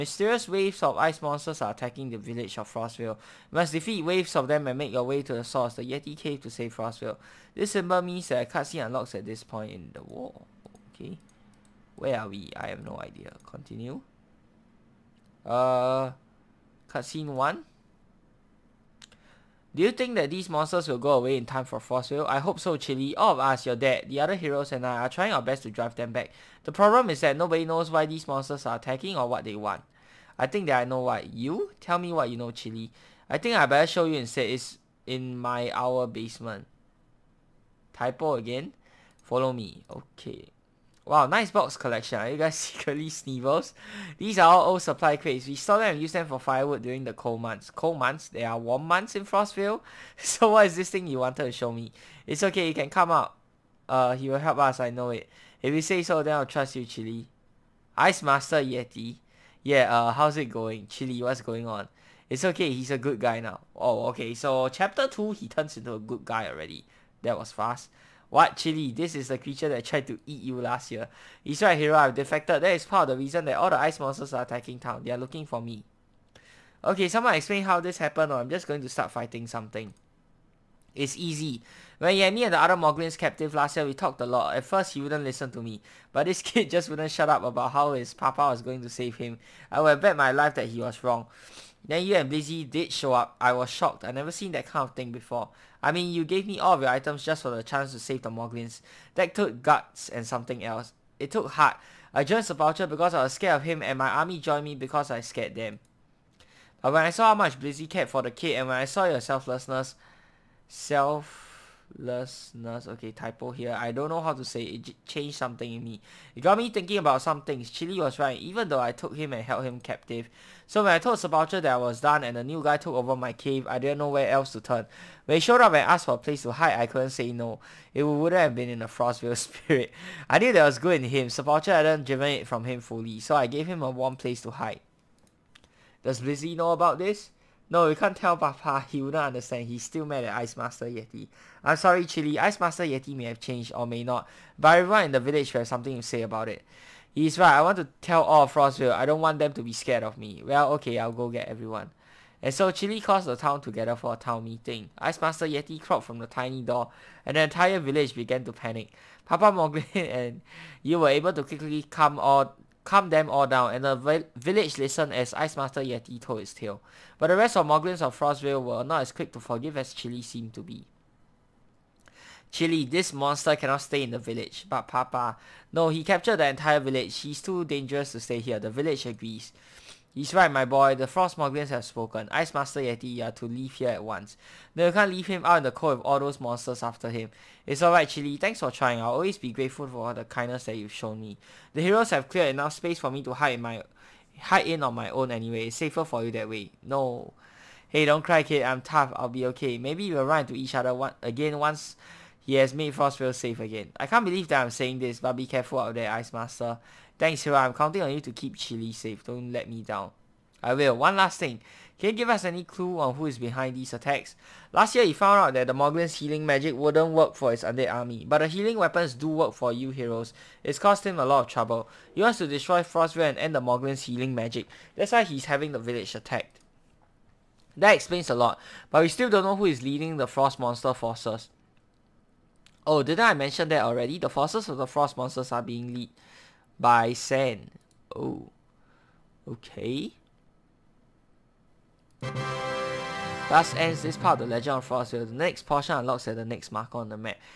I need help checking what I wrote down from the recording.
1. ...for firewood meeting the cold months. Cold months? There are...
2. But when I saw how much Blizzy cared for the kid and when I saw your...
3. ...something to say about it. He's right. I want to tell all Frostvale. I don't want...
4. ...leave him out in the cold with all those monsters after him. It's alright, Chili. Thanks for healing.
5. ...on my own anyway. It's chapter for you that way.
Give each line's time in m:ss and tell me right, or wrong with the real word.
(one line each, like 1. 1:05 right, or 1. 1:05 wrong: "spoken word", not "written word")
1. 0:46 wrong: "during", not "meeting"
2. 1:46 right
3. 2:25 right
4. 3:05 wrong: "trying", not "healing"
5. 3:14 wrong: "safer", not "chapter".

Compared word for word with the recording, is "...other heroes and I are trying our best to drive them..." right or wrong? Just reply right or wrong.
right.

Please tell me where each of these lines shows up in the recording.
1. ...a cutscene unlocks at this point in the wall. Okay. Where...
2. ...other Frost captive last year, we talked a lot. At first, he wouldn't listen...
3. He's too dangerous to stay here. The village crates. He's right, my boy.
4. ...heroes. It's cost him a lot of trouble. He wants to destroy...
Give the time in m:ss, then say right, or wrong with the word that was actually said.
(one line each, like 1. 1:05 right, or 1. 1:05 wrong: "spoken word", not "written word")
1. 0:08 right
2. 1:22 wrong: "Moglins", not "Frost"
3. 2:57 wrong: "agrees", not "crates"
4. 3:39 right.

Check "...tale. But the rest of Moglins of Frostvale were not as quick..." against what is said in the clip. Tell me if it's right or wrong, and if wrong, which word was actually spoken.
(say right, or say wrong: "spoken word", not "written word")
right.